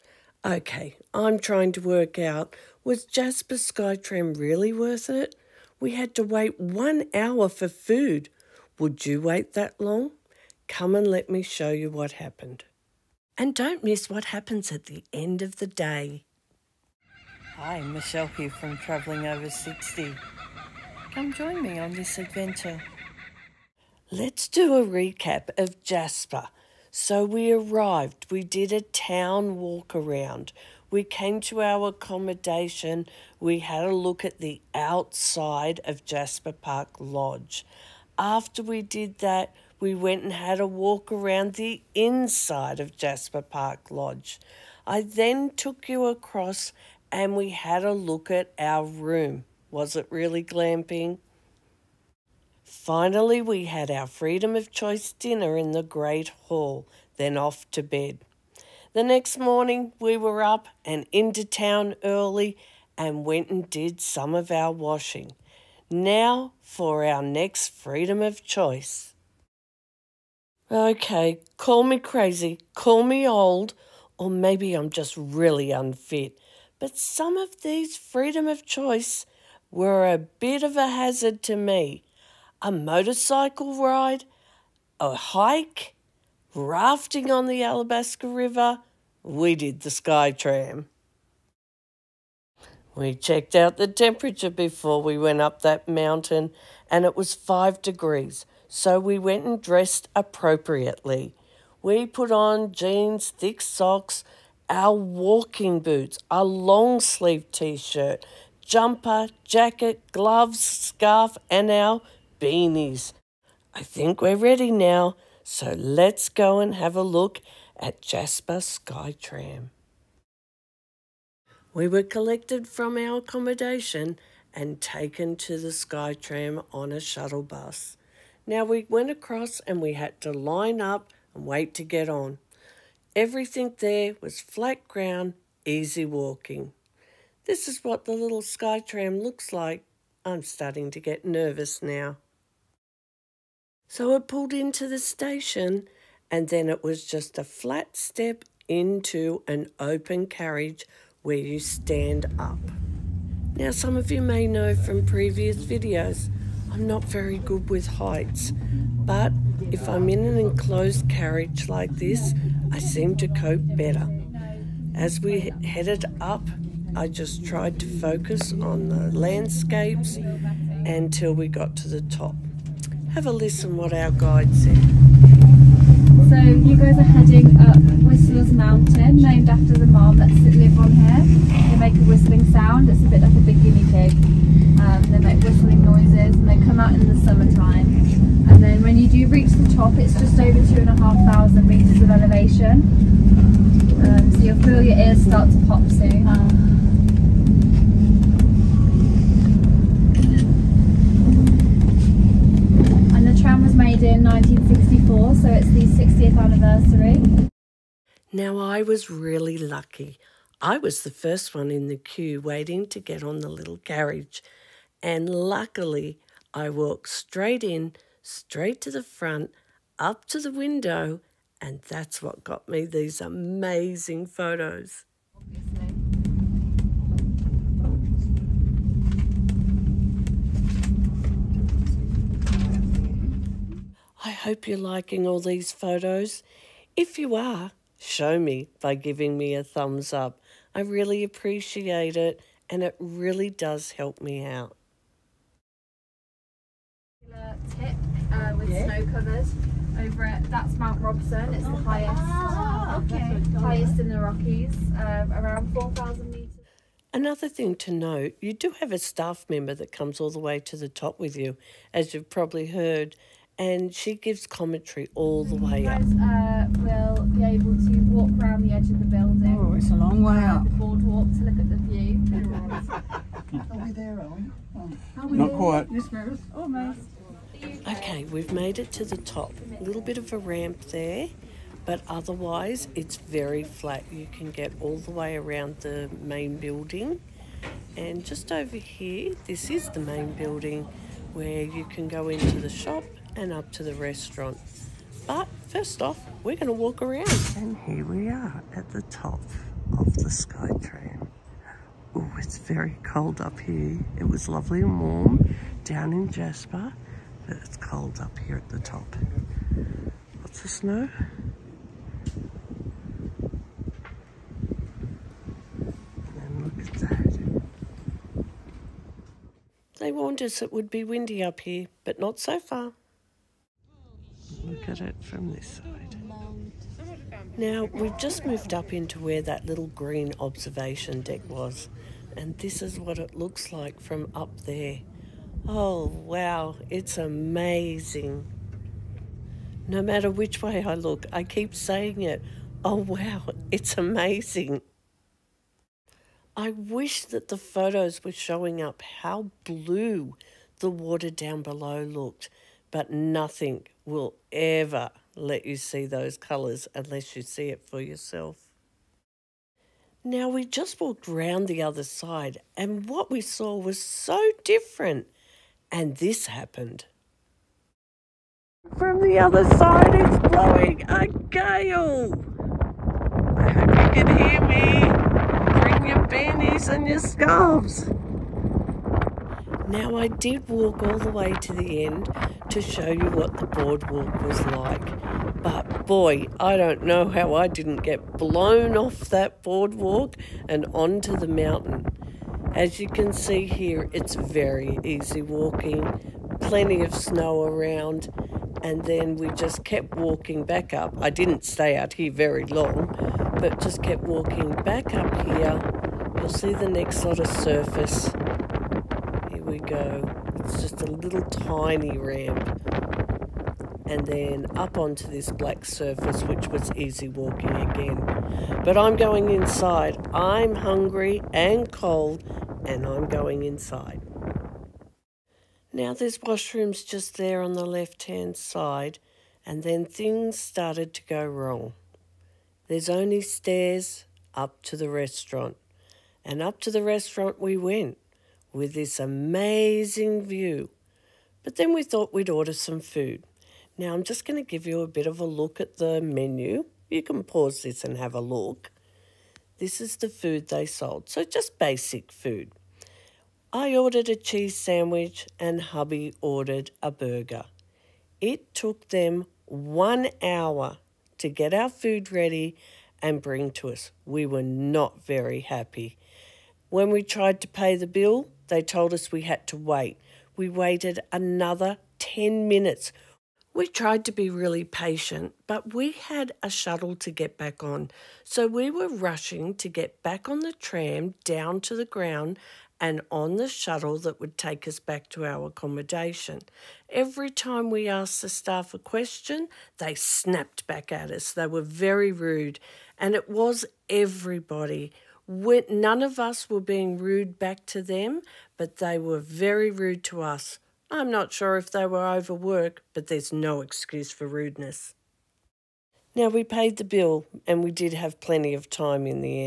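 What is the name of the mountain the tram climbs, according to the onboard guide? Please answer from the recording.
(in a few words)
Whistler's Mountain.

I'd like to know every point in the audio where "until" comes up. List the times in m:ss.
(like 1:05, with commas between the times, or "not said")
2:50.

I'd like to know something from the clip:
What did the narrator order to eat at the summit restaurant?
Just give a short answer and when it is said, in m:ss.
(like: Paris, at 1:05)
a cheese sandwich, at 7:34.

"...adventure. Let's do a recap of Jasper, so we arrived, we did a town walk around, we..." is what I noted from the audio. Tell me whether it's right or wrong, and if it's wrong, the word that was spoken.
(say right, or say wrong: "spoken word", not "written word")
right.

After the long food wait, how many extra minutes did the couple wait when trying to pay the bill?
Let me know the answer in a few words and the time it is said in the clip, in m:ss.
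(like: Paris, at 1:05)
10 minutes, at 7:52.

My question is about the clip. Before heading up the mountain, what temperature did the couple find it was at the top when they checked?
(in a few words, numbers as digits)
5 degrees.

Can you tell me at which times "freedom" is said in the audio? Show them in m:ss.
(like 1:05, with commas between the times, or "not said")
0:54, 1:07, 1:17.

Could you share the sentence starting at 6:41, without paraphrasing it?
I didn't stay out here very long, but just kept walking back up here.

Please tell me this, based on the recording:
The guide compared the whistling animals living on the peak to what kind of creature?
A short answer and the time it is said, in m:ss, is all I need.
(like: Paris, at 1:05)
a big guinea pig, at 3:03.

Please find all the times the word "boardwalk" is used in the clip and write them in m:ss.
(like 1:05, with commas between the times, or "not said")
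4:30, 6:23, 6:29.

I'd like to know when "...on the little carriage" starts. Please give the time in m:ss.
3:33.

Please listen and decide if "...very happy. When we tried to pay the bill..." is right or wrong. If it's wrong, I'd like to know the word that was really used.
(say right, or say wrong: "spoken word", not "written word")
right.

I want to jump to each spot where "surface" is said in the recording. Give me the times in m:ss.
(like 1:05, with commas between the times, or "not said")
6:47, 6:55.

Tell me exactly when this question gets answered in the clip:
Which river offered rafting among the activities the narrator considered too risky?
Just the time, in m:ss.
1:27.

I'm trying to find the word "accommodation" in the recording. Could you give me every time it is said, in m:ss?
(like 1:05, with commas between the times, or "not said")
0:31, 2:03, 8:05.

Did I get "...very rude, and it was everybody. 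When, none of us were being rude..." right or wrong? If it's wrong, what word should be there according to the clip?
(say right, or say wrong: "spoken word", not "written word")
right.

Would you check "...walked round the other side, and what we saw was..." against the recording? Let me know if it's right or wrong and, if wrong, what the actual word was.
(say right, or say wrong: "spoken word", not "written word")
right.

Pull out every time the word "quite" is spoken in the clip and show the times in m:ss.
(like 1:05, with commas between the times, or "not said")
4:35.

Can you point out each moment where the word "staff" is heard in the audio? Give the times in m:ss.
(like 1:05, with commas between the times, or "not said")
4:18, 8:08.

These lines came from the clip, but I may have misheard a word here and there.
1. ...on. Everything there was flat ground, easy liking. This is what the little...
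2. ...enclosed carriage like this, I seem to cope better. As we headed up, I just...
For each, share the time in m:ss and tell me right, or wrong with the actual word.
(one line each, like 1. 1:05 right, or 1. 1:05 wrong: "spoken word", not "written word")
1. 2:12 wrong: "walking", not "liking"
2. 2:40 right.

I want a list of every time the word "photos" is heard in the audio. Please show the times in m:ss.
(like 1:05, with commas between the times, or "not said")
3:44, 3:55, 5:47.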